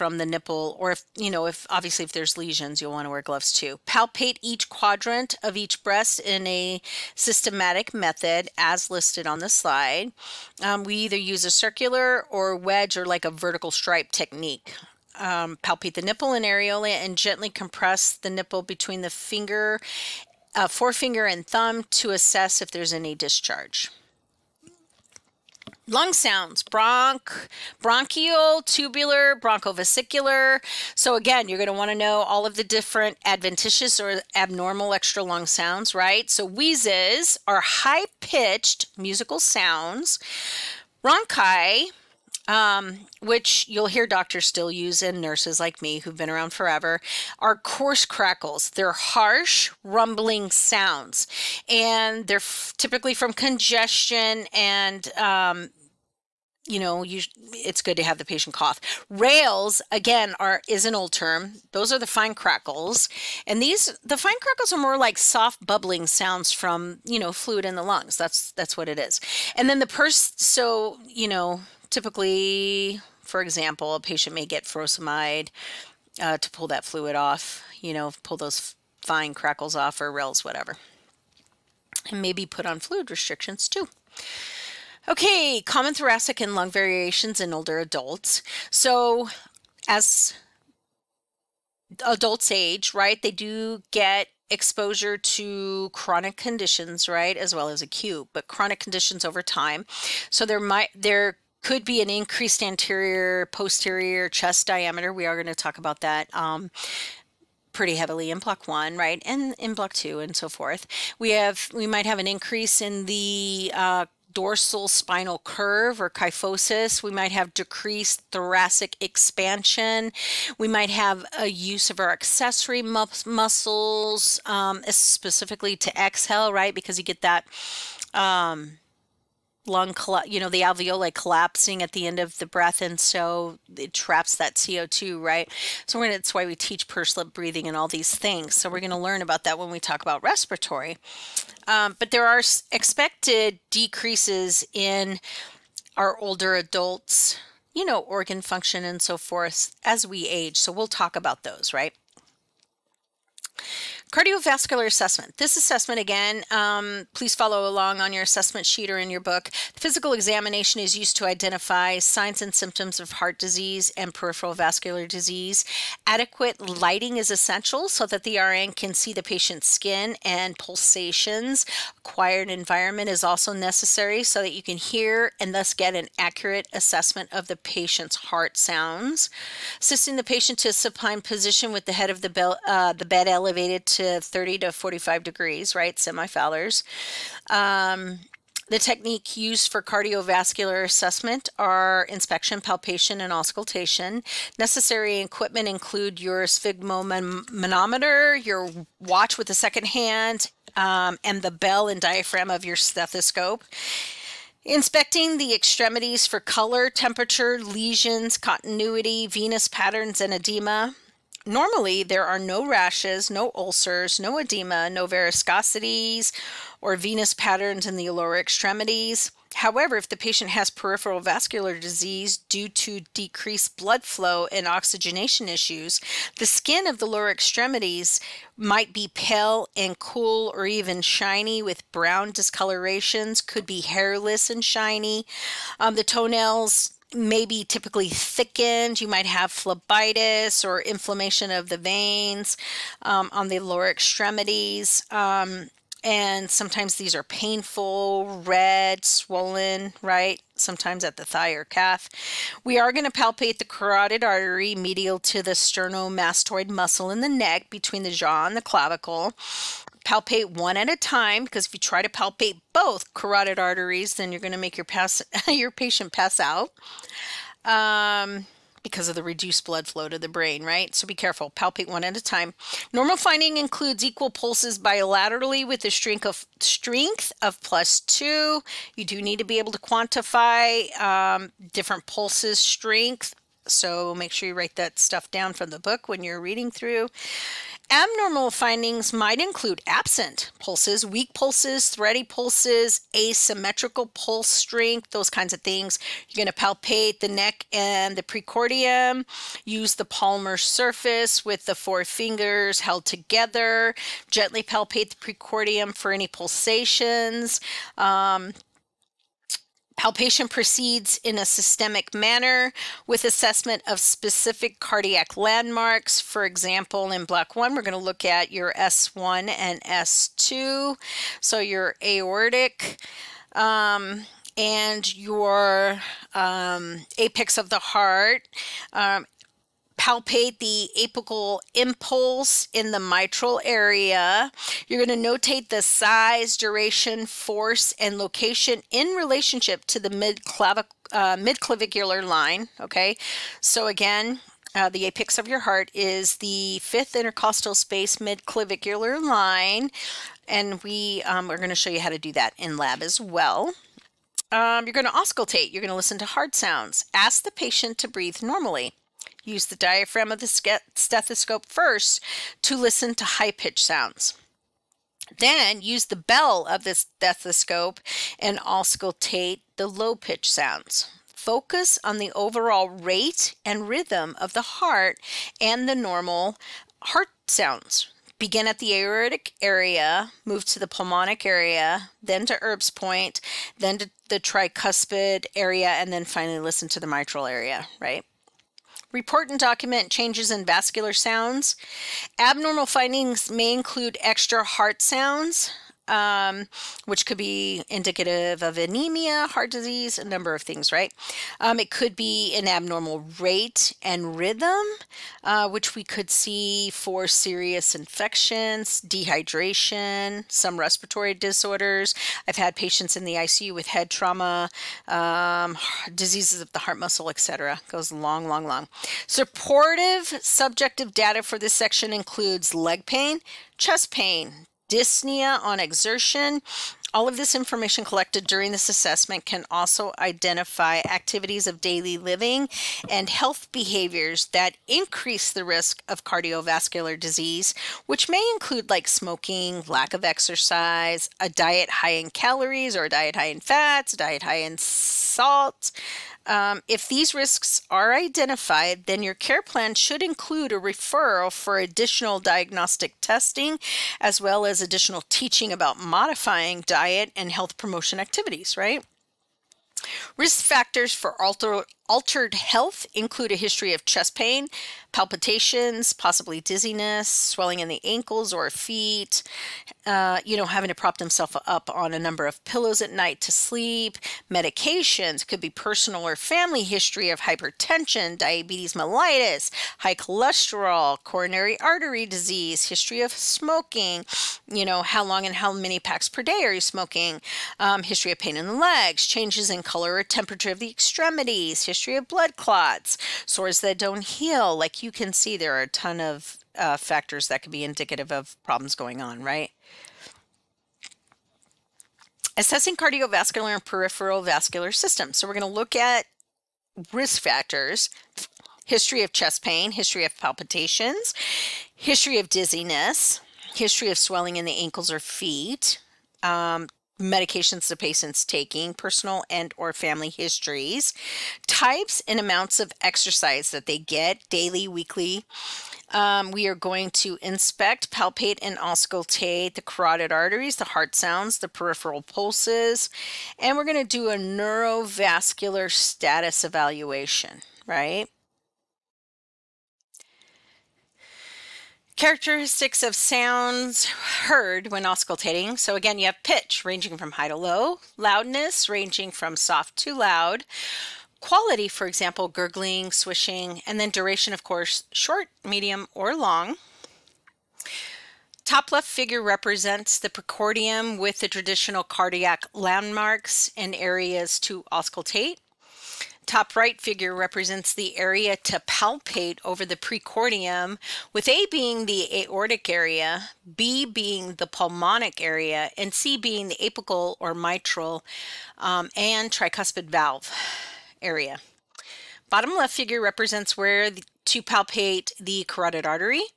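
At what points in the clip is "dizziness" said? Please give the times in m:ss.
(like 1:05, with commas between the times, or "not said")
7:46, 8:32.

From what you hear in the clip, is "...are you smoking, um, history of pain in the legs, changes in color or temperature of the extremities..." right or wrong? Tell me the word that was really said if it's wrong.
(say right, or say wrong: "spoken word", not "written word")
right.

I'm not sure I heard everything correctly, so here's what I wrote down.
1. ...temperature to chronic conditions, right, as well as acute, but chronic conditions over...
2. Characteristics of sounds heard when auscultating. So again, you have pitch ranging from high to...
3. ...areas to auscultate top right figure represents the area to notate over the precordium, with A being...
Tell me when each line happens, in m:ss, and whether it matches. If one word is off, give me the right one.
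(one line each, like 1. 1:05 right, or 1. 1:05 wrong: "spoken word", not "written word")
1. 1:34 wrong: "exposure", not "temperature"
2. 9:02 right
3. 9:23 wrong: "palpate", not "notate".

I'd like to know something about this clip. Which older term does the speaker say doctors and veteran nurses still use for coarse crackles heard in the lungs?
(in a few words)
Bronchi.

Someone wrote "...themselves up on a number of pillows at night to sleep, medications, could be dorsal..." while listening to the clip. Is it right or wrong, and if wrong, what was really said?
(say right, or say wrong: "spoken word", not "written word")
wrong: "personal", not "dorsal".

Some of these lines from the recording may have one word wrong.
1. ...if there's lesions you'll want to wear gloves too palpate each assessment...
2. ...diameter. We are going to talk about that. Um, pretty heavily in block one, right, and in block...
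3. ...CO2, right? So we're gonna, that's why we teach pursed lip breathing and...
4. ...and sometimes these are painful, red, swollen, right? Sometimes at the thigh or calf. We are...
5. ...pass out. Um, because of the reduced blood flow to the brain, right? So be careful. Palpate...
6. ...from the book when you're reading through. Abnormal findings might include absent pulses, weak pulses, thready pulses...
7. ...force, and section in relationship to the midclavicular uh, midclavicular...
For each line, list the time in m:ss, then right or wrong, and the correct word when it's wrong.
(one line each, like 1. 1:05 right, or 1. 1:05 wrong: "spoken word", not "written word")
1. 0:02 wrong: "quadrant", not "assessment"
2. 1:44 right
3. 2:14 right
4. 4:06 right
5. 4:26 right
6. 4:45 right
7. 5:37 wrong: "location", not "section".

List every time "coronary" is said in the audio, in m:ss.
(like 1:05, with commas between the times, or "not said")
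8:01.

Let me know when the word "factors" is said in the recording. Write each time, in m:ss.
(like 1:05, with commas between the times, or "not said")
7:40, 8:16, 8:27.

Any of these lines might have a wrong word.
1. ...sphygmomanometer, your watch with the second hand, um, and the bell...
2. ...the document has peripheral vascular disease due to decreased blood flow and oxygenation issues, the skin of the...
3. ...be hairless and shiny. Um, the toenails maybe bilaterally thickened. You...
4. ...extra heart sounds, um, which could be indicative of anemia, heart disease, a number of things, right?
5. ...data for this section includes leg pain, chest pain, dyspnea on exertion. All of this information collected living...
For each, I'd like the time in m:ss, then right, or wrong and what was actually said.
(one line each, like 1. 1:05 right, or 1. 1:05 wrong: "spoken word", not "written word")
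1. 3:16 right
2. 3:40 wrong: "patient", not "document"
3. 3:53 wrong: "typically", not "bilaterally"
4. 6:34 right
5. 7:01 wrong: "during", not "living".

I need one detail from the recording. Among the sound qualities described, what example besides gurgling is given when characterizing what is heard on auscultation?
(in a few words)
Swishing.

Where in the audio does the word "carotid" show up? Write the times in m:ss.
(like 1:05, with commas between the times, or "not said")
4:13, 4:23, 8:49, 9:45.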